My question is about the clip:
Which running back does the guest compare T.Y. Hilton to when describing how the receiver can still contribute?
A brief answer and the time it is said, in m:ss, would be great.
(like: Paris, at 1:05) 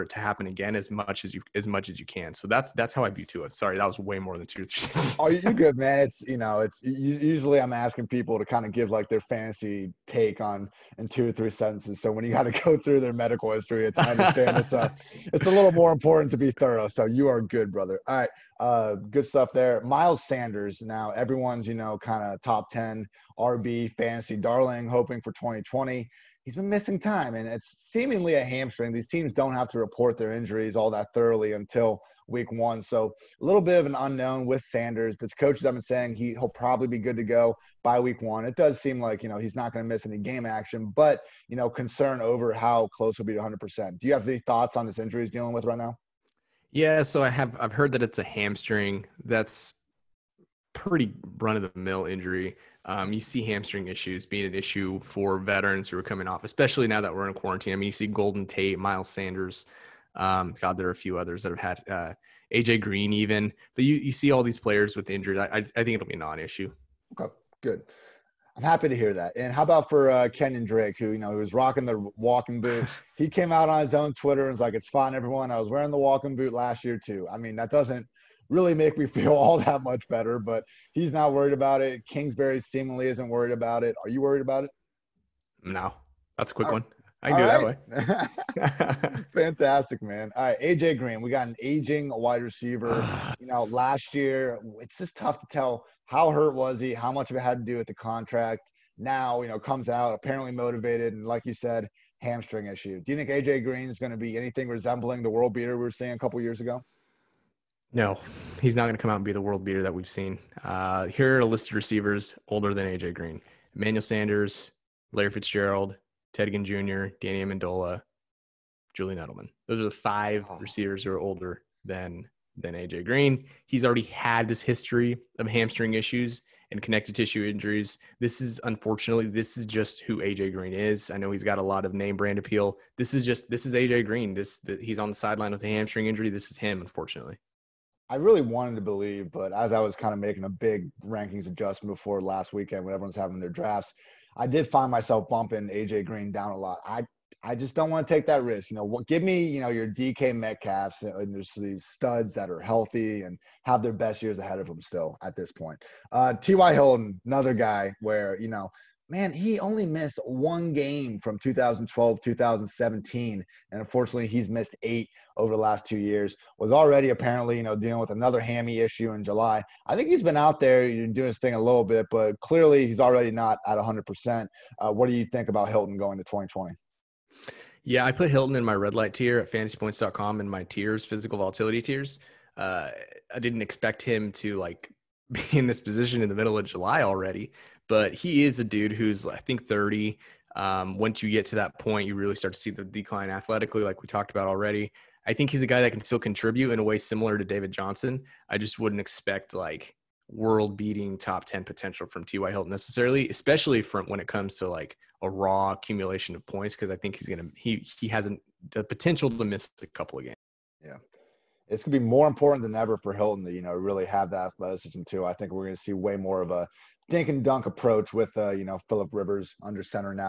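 David Johnson, at 3:17.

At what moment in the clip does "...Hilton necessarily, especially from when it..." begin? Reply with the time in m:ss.
3:22.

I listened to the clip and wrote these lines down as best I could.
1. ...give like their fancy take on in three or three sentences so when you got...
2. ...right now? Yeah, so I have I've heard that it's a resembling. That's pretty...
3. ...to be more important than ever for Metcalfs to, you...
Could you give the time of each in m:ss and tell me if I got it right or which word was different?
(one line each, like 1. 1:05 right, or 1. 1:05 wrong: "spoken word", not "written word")
1. 0:08 wrong: "two", not "three"
2. 0:45 wrong: "hamstring", not "resembling"
3. 3:31 wrong: "Hilton", not "Metcalfs".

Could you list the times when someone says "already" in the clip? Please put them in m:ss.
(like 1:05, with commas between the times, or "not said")
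2:03, 2:46, 2:53, 3:07, 3:14.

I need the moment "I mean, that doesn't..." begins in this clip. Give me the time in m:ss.
1:17.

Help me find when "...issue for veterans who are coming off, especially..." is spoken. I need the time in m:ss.
0:54.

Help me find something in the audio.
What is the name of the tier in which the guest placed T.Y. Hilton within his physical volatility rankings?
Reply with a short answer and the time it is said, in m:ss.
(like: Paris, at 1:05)
red light tier, at 2:58.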